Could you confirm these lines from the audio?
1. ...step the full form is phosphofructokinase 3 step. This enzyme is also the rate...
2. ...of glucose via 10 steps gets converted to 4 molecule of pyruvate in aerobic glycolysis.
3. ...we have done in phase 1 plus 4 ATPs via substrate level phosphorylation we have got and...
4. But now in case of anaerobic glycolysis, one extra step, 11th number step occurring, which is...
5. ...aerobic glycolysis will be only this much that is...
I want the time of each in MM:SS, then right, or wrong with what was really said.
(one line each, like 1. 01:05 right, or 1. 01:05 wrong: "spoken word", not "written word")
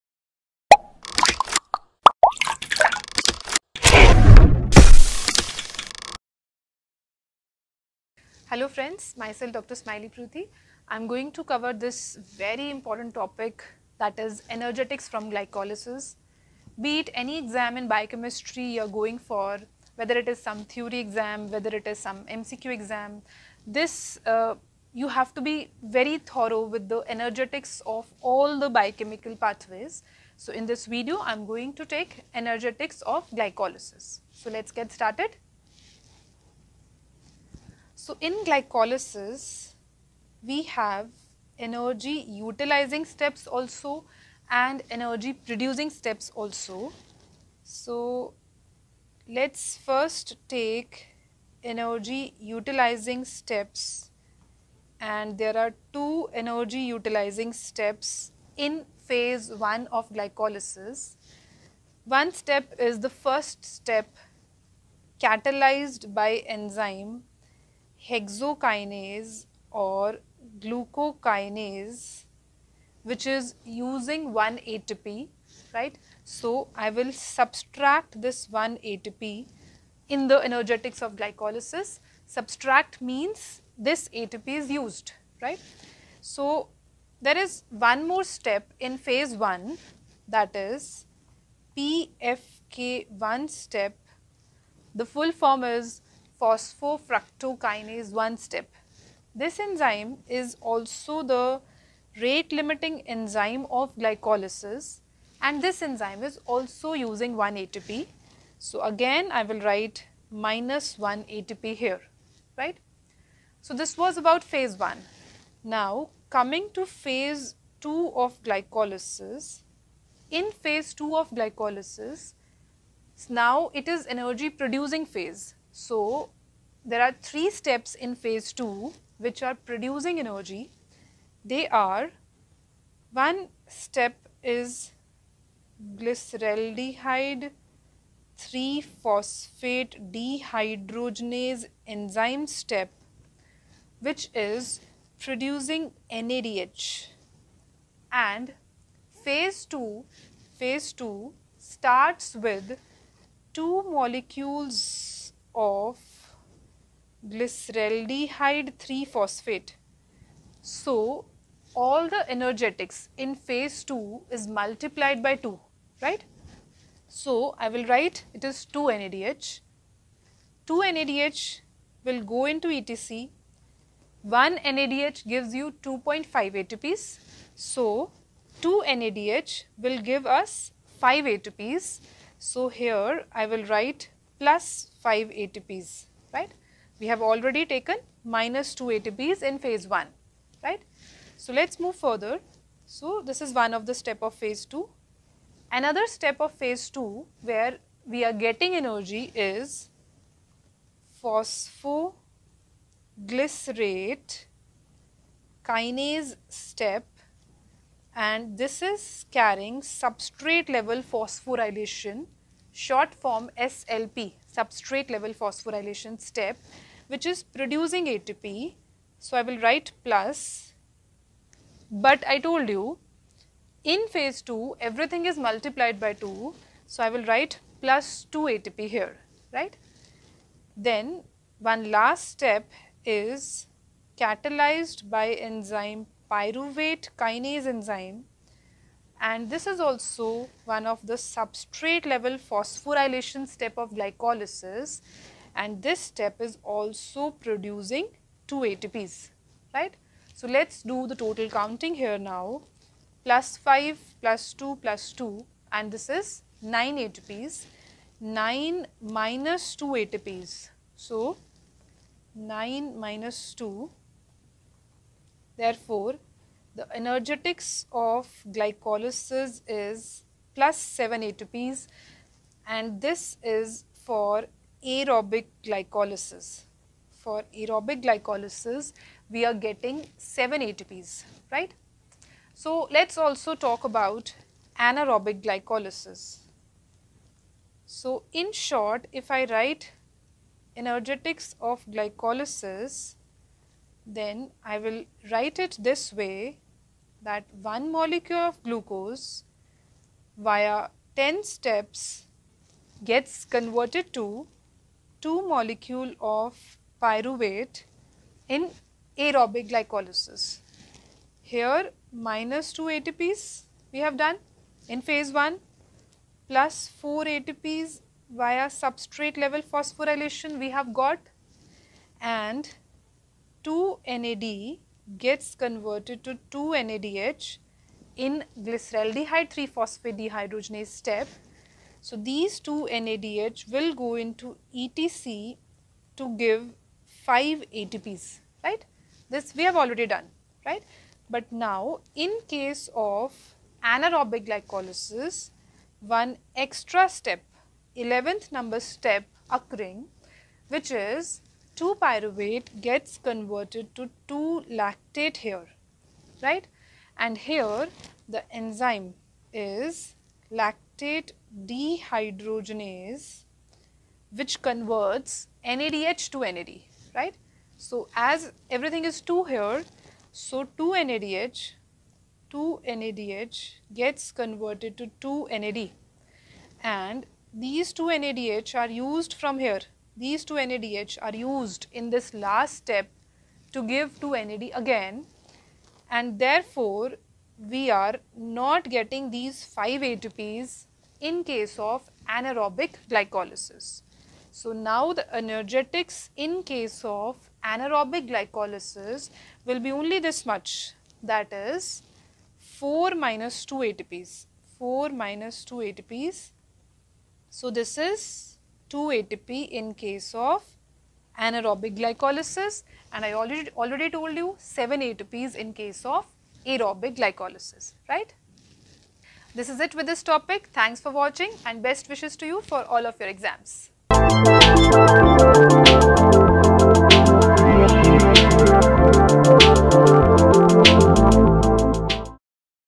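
1. 01:33 wrong: "1", not "3"
2. 04:58 wrong: "2", not "4"
3. 05:13 right
4. 05:41 right
5. 06:37 wrong: "anaerobic", not "aerobic".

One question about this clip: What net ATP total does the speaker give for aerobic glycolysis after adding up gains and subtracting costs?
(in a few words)
7 ATPs.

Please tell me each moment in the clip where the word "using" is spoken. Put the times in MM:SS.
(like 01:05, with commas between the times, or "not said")
01:13, 01:46.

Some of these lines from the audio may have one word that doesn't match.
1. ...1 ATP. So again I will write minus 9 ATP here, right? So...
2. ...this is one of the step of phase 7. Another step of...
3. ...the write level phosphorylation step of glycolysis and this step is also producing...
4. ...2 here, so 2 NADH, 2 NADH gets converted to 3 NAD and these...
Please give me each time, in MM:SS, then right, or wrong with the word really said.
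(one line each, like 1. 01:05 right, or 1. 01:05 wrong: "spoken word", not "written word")
1. 01:47 wrong: "1", not "9"
2. 03:13 wrong: "2", not "7"
3. 04:01 wrong: "substrate", not "write"
4. 06:09 wrong: "2", not "3".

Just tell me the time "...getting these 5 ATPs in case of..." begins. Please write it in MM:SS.
06:28.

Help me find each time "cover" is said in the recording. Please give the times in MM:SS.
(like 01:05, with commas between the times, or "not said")
00:11.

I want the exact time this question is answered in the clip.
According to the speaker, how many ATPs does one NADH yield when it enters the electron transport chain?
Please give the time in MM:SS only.
02:55.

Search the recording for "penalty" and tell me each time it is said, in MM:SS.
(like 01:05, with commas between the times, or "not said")
not said.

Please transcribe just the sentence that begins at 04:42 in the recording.
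So, let's also talk about anaerobic glycolysis.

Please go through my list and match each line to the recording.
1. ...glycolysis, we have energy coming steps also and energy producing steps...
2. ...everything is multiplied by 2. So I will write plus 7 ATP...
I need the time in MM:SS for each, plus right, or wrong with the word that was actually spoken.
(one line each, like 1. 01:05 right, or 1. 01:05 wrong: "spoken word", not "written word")
1. 00:38 wrong: "utilizing", not "coming"
2. 03:44 wrong: "2", not "7".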